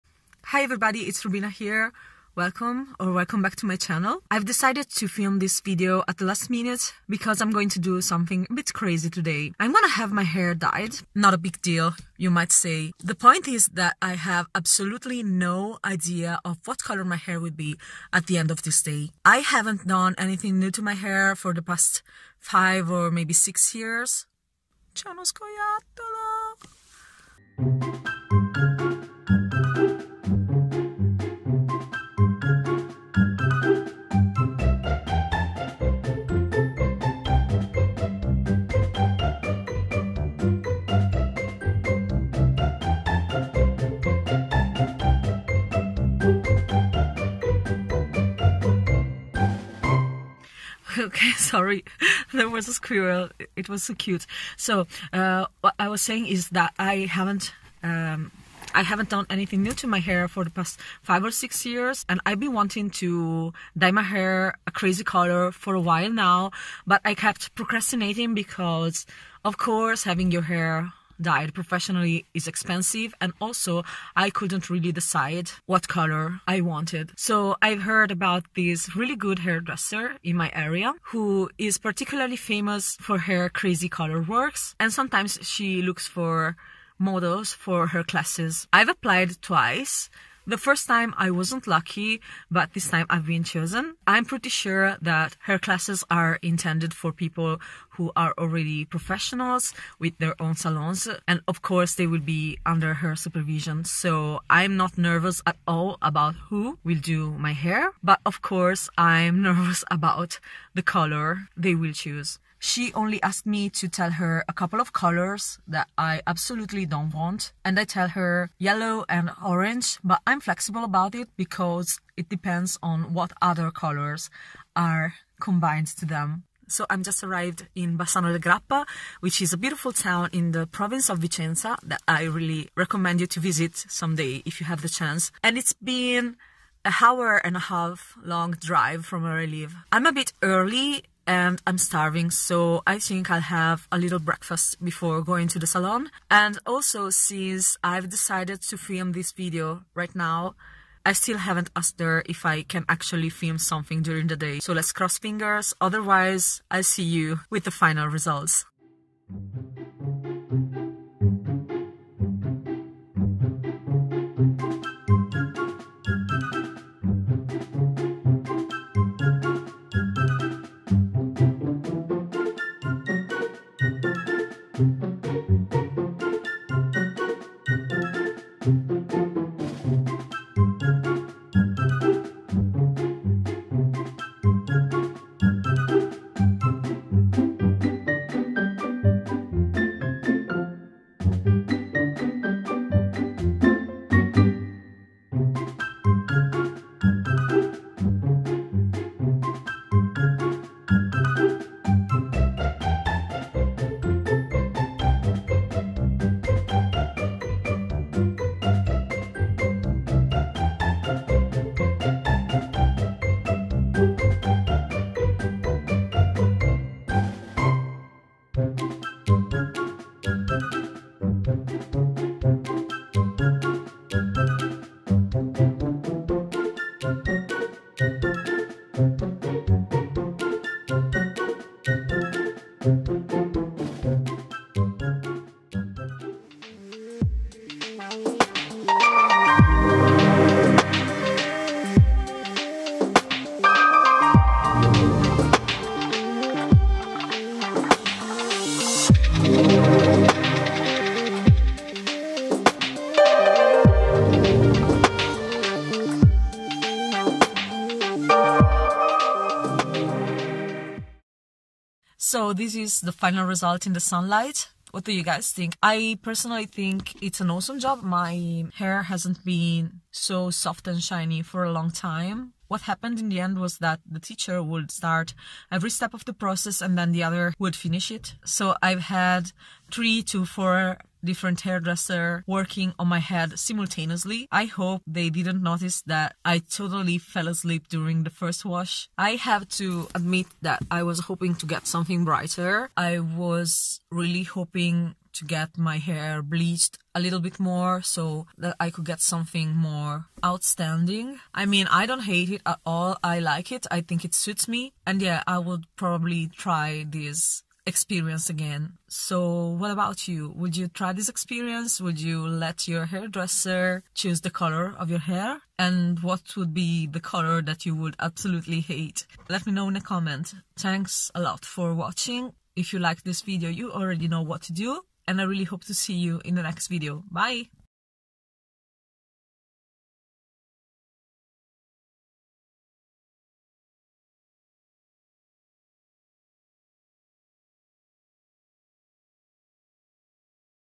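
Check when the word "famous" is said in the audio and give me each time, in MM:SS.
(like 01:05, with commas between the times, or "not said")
01:22.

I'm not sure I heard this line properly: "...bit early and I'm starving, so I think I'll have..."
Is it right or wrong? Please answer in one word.
right.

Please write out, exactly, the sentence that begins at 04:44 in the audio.
I hope they didn't notice that I totally fell asleep during the first wash.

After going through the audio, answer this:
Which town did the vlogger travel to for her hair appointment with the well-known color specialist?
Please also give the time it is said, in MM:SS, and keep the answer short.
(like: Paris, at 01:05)
Bassano del Grappa, at 02:07.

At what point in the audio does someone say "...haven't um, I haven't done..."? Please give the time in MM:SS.
00:57.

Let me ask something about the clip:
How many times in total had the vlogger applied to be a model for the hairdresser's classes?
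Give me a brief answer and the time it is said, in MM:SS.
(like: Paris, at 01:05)
twice, at 01:29.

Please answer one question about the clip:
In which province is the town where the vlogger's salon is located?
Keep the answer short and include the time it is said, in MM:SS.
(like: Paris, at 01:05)
Vicenza, at 02:11.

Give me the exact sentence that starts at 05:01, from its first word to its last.
I mean, I don't hate it at all.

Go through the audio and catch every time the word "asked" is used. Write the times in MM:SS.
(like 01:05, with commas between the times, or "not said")
01:53, 02:31.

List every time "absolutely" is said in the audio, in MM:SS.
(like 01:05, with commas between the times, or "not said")
00:14, 01:56, 05:18.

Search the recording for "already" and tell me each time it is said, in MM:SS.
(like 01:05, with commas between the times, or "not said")
01:38, 05:23.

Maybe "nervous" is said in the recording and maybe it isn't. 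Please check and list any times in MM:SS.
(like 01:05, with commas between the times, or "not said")
01:44, 01:49.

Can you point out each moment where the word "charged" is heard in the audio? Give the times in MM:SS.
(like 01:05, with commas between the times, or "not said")
not said.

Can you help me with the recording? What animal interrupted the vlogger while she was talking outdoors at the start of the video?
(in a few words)
squirrel.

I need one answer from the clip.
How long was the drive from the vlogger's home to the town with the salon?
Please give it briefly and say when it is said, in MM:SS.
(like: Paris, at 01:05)
an hour and a half, at 02:16.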